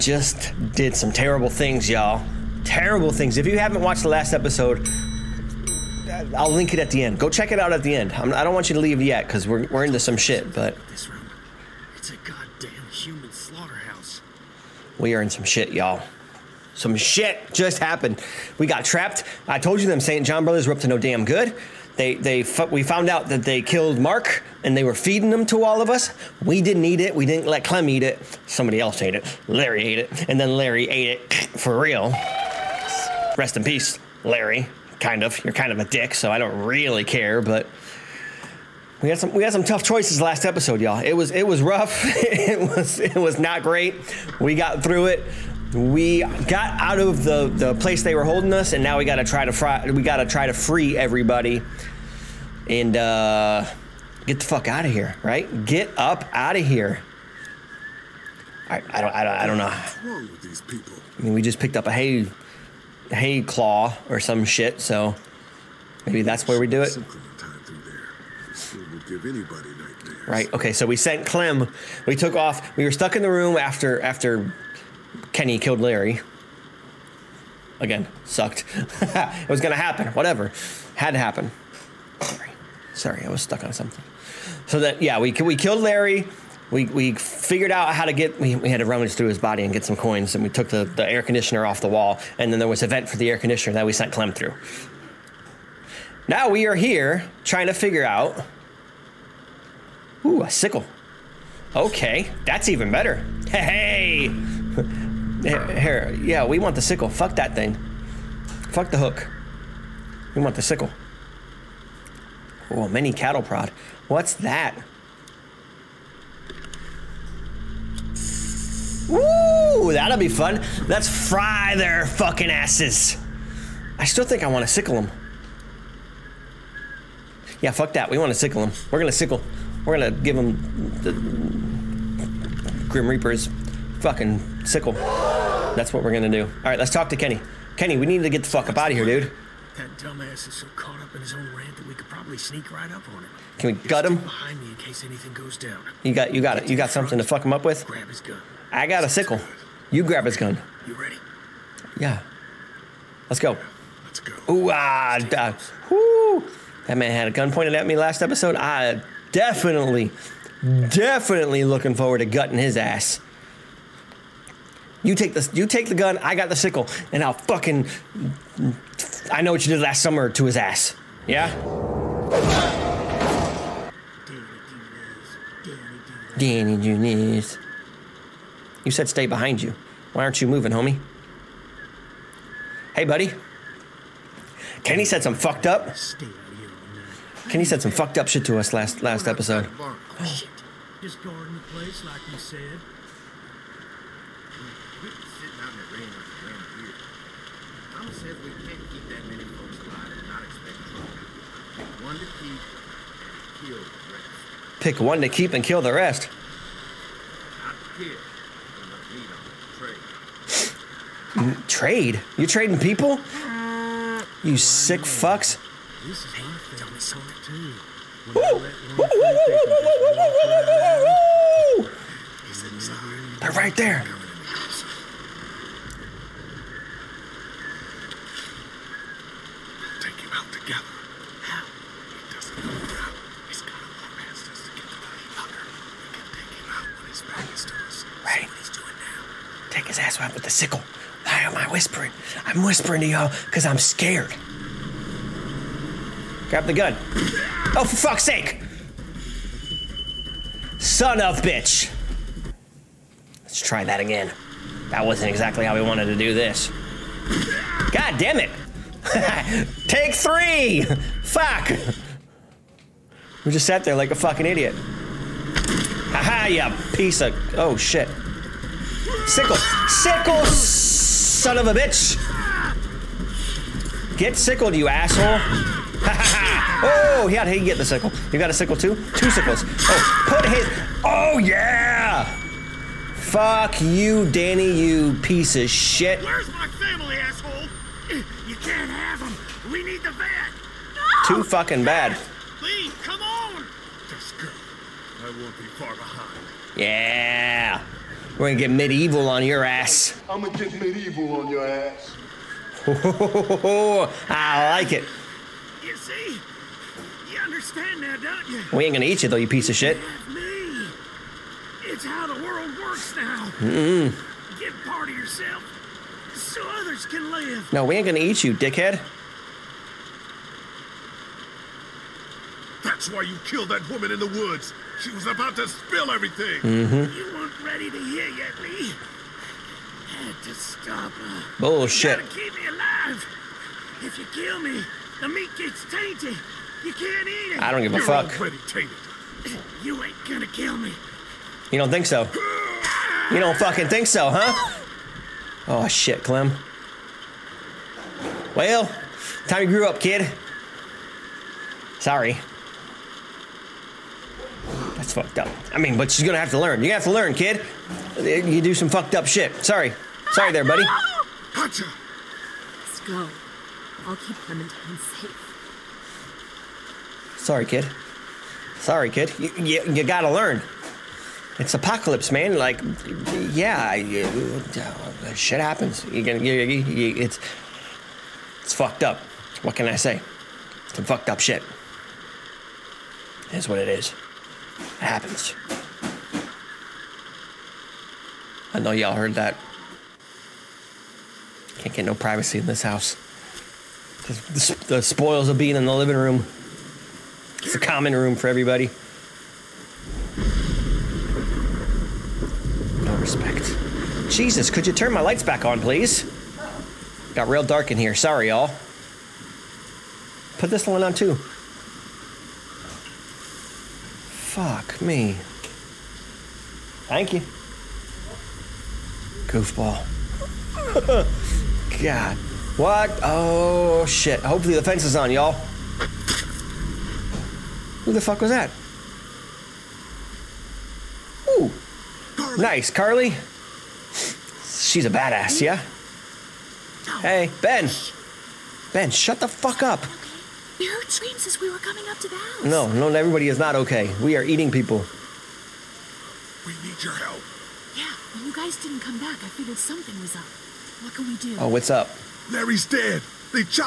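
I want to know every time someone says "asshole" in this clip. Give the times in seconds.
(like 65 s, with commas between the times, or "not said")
274 s, 287 s.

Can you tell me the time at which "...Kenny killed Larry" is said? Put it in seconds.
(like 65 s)
75 s.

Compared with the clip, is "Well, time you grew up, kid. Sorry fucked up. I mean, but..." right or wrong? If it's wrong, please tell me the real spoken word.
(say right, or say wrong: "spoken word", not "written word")
right.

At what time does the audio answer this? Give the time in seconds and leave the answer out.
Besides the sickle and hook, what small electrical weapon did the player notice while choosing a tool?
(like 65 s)
112 s.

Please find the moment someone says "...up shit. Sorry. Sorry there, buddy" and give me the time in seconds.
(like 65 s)
359 s.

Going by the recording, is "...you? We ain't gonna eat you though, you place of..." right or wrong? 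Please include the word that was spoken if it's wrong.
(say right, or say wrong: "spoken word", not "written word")
wrong: "piece", not "place".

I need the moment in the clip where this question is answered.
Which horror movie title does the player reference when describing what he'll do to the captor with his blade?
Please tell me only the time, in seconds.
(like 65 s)
169 s.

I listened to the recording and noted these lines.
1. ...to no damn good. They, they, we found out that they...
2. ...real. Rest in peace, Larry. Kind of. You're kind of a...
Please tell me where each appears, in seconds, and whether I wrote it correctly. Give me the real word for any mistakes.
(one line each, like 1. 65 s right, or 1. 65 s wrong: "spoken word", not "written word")
1. 20 s right
2. 31 s right.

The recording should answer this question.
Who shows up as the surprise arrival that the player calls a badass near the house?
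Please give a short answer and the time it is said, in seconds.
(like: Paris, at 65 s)
Carley, at 432 s.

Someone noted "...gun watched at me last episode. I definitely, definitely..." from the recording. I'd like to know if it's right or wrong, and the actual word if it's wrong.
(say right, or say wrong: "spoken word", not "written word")
wrong: "pointed", not "watched".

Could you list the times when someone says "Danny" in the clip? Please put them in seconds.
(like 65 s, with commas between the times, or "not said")
176 s, 284 s.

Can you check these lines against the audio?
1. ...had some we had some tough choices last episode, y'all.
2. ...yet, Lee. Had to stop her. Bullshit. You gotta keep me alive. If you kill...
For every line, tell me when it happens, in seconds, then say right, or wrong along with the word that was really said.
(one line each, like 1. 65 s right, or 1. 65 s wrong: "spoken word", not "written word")
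1. 39 s right
2. 328 s right.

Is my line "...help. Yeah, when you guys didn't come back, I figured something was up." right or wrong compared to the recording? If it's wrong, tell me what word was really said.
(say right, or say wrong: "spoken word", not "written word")
right.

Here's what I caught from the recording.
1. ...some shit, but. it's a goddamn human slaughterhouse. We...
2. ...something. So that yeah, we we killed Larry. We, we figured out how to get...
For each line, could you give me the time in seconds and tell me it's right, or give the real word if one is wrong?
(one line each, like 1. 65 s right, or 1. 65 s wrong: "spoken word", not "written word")
1. 9 s right
2. 83 s right.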